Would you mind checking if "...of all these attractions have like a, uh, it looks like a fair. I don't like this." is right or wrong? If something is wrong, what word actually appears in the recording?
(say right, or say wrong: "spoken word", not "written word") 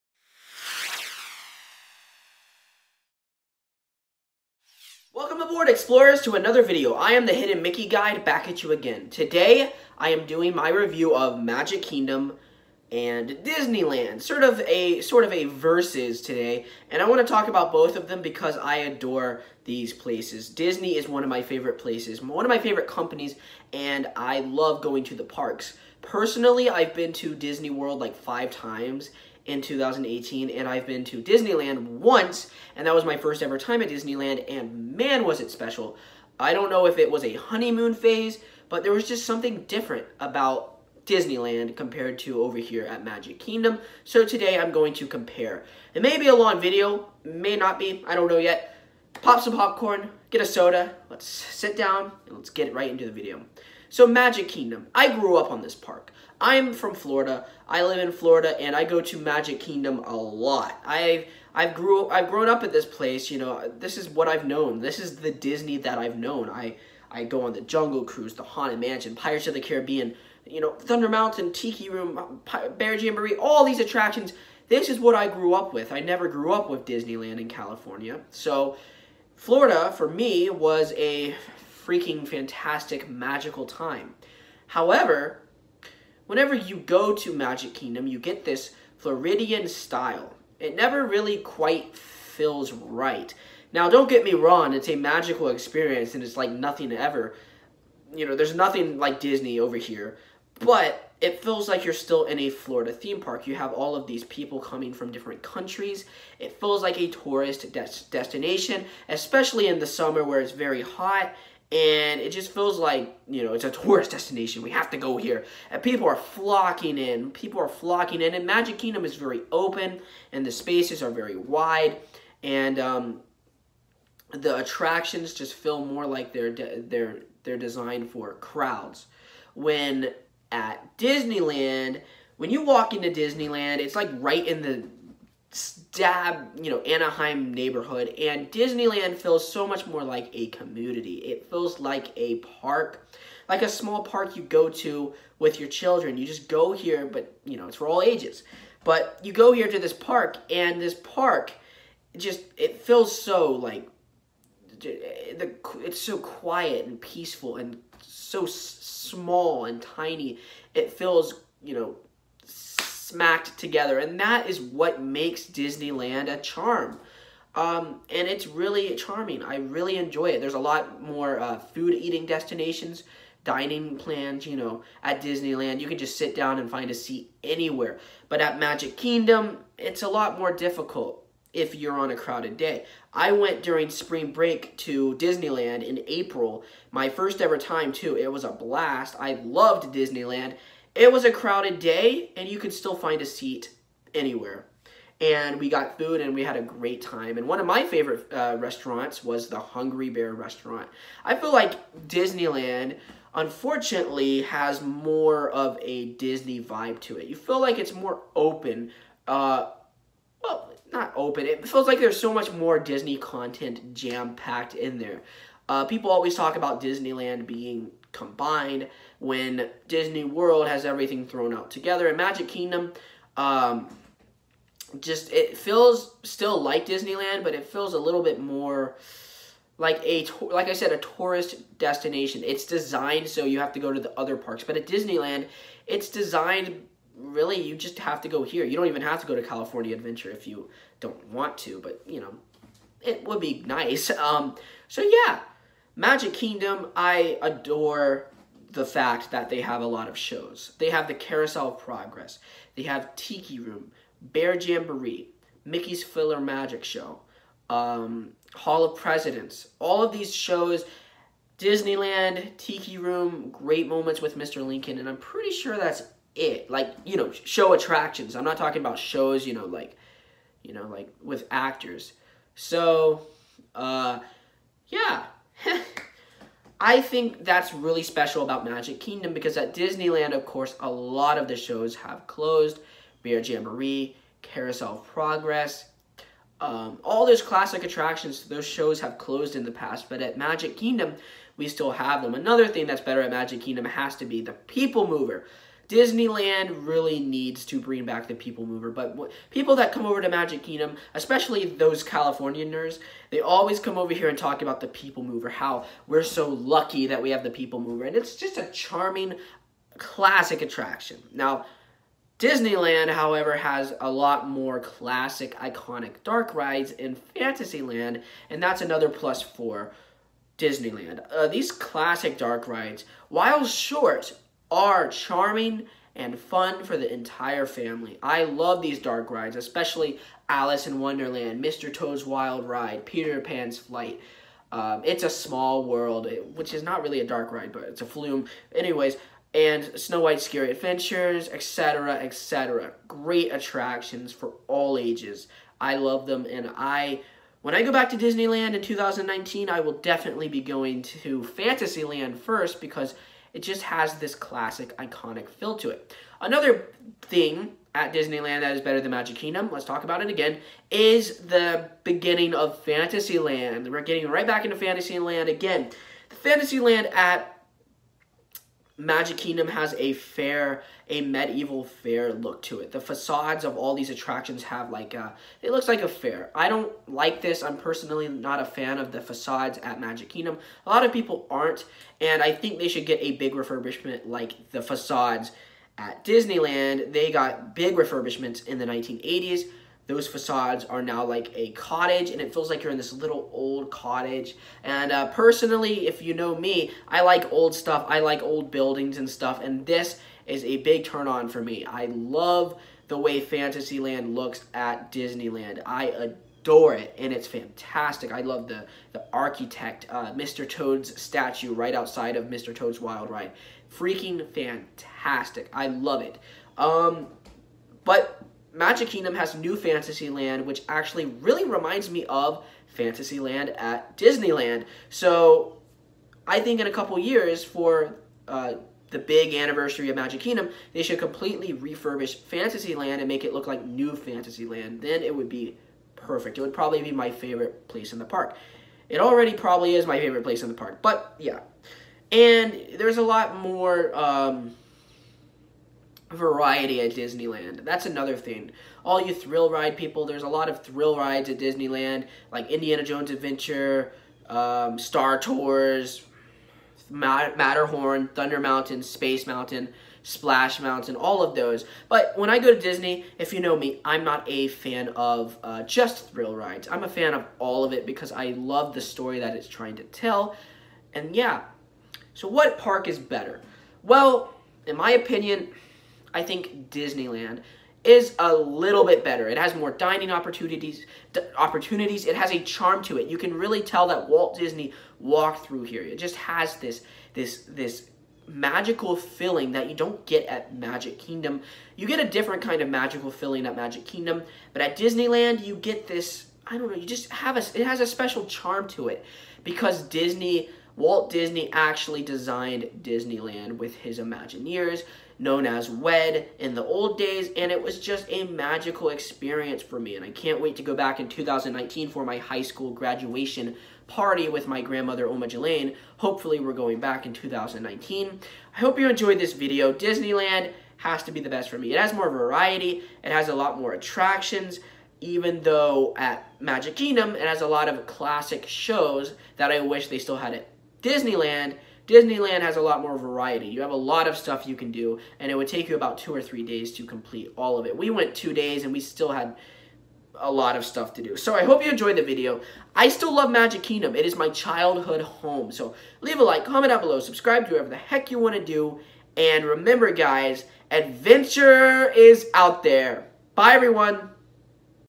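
right.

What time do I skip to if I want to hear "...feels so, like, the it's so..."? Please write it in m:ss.
2:32.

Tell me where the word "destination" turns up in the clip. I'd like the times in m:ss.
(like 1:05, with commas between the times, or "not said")
1:48, 1:54, 2:52, 3:51.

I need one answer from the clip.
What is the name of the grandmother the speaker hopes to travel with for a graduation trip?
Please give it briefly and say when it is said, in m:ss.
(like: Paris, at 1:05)
Oma Jelaine, at 8:35.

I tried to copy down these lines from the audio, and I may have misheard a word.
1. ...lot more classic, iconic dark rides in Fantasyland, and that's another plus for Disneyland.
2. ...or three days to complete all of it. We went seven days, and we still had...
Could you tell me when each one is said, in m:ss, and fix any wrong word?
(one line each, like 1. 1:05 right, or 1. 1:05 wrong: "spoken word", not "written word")
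1. 5:14 right
2. 8:56 wrong: "two", not "seven".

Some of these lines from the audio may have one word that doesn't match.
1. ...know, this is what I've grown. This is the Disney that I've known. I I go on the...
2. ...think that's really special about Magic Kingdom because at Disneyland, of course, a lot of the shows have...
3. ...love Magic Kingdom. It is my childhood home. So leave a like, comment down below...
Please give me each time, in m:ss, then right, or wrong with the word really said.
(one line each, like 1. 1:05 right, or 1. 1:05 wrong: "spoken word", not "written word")
1. 1:03 wrong: "known", not "grown"
2. 4:36 right
3. 9:03 right.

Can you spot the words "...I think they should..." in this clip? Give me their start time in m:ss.
6:22.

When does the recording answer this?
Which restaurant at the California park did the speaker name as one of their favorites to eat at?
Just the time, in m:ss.
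3:19.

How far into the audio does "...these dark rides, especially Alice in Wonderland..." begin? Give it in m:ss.
5:28.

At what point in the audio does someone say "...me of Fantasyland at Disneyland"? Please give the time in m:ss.
7:02.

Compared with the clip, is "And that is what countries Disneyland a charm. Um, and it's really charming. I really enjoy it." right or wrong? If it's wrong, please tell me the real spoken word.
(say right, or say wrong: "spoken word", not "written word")
wrong: "makes", not "countries".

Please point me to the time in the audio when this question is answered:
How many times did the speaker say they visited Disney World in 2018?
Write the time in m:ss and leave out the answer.
0:28.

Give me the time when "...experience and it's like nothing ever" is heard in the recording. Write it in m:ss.
1:35.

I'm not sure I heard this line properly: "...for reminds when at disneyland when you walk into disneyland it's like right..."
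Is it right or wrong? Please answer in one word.
wrong.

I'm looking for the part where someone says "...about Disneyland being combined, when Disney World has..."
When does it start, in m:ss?
3:36.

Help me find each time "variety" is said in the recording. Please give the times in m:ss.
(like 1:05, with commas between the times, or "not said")
7:26, 8:42, 8:53.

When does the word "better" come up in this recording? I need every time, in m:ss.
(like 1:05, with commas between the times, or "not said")
4:53, 5:58, 7:53, 7:59.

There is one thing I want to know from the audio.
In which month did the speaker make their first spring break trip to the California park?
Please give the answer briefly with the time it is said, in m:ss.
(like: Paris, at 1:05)
April, at 3:06.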